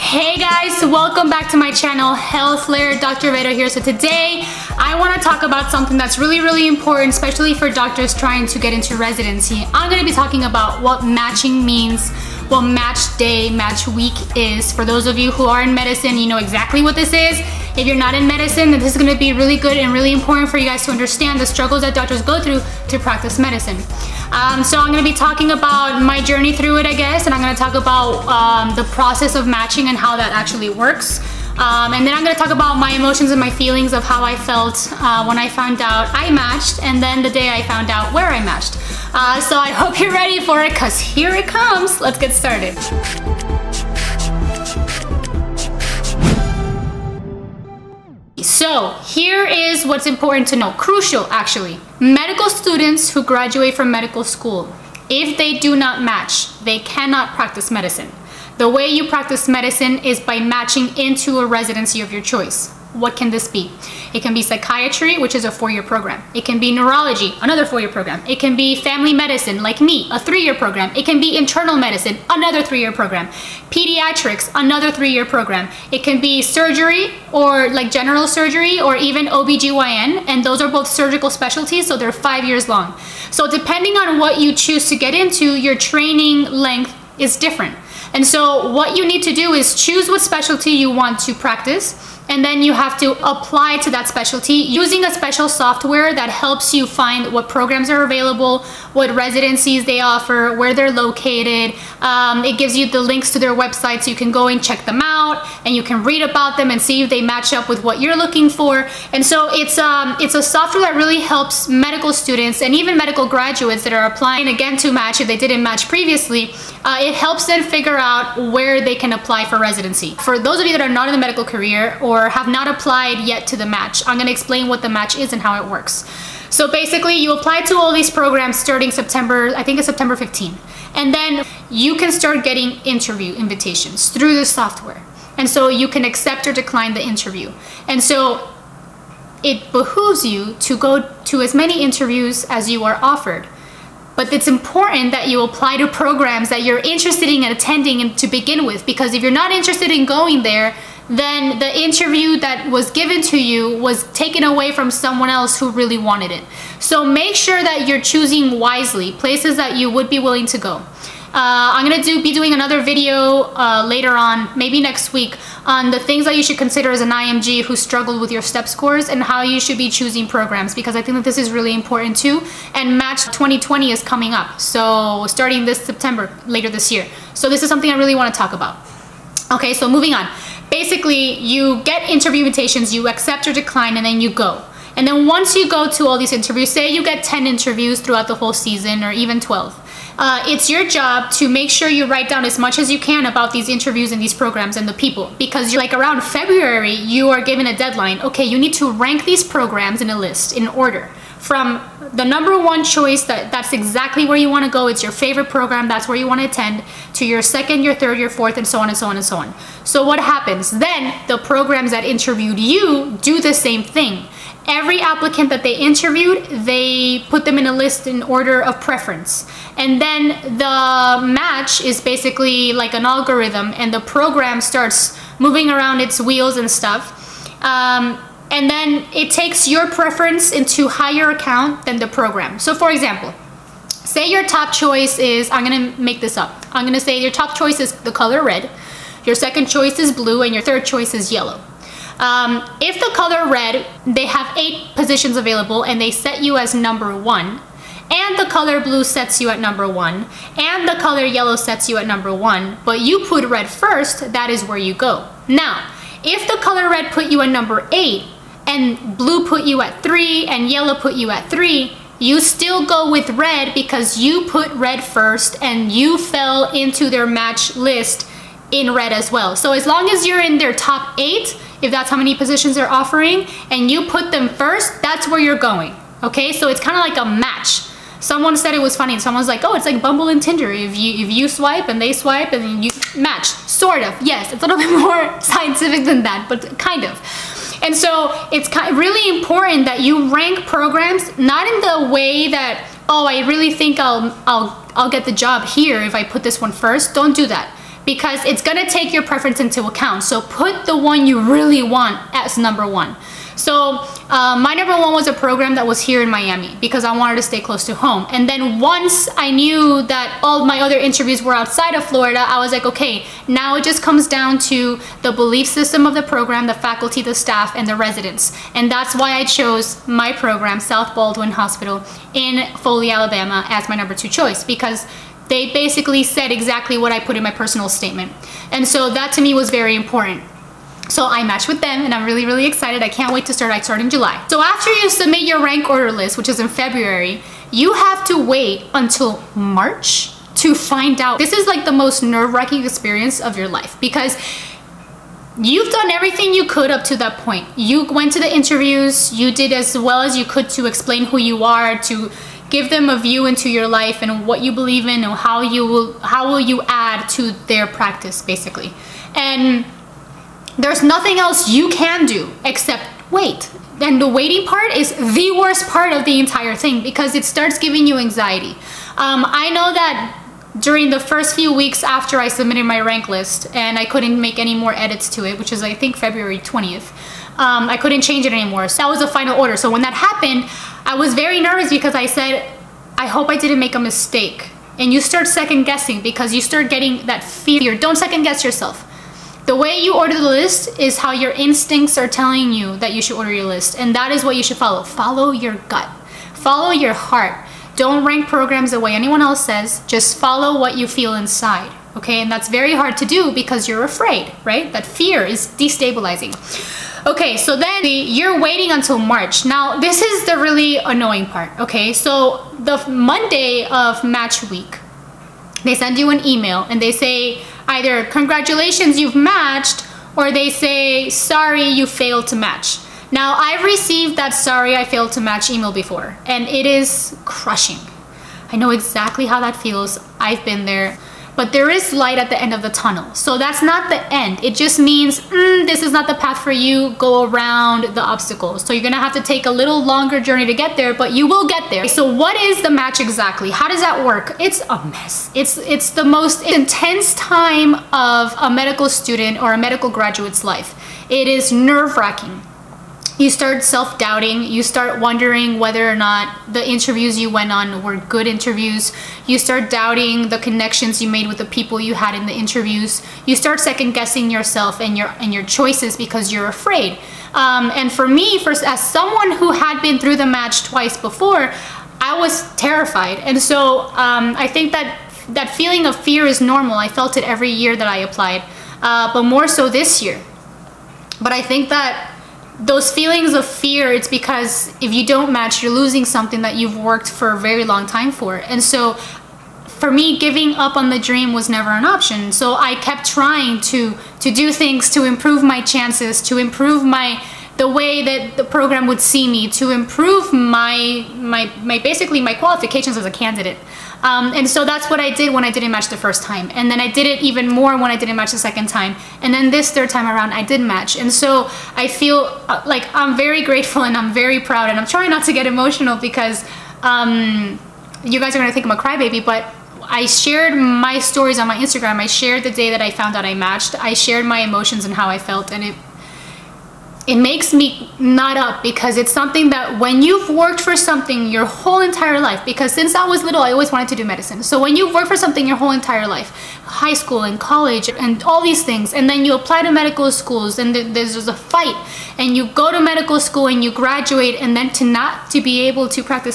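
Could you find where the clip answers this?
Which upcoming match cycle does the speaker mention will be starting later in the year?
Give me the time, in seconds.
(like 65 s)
172 s.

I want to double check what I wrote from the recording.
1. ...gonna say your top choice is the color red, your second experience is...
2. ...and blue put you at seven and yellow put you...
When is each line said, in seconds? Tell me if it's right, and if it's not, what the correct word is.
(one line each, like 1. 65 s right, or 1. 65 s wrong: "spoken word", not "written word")
1. 236 s wrong: "choice", not "experience"
2. 258 s wrong: "three", not "seven".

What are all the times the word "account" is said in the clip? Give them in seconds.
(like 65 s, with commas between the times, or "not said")
231 s, 299 s.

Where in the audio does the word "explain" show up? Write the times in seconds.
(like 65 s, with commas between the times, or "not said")
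124 s, 350 s.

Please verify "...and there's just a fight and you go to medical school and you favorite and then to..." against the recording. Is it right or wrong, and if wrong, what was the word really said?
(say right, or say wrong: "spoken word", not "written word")
wrong: "graduate", not "favorite".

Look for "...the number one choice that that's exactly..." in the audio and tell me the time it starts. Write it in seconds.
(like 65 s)
202 s.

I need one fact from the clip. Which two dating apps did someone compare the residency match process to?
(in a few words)
Bumble and Tinder.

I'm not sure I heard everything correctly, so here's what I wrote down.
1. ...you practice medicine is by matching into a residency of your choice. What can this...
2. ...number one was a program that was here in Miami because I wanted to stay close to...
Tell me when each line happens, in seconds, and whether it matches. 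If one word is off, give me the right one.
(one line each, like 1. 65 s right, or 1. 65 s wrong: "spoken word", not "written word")
1. 58 s right
2. 304 s right.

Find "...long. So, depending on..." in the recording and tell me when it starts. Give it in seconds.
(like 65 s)
82 s.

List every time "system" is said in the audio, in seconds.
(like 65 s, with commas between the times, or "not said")
315 s.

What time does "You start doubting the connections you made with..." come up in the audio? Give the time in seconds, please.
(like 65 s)
459 s.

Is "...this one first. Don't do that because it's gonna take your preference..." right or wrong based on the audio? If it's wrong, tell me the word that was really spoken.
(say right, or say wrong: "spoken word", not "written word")
right.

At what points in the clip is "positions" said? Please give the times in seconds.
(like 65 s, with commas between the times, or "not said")
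244 s, 272 s.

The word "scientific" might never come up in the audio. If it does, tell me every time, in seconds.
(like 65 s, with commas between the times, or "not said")
285 s.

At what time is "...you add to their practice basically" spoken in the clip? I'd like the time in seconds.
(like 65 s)
356 s.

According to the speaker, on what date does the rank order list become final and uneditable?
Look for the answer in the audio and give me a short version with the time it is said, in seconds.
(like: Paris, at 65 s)
February 20, at 376 s.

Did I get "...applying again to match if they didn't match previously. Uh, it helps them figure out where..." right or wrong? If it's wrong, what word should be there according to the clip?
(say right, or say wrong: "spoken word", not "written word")
right.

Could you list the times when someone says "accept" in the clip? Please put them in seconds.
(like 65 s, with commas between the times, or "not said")
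136 s, 183 s.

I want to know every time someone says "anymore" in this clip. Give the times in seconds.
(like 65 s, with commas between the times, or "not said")
378 s.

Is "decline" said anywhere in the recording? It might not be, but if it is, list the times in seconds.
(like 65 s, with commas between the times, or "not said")
136 s, 183 s.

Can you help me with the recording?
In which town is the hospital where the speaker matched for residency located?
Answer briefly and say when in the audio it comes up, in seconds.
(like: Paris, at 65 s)
Foley, Alabama, at 322 s.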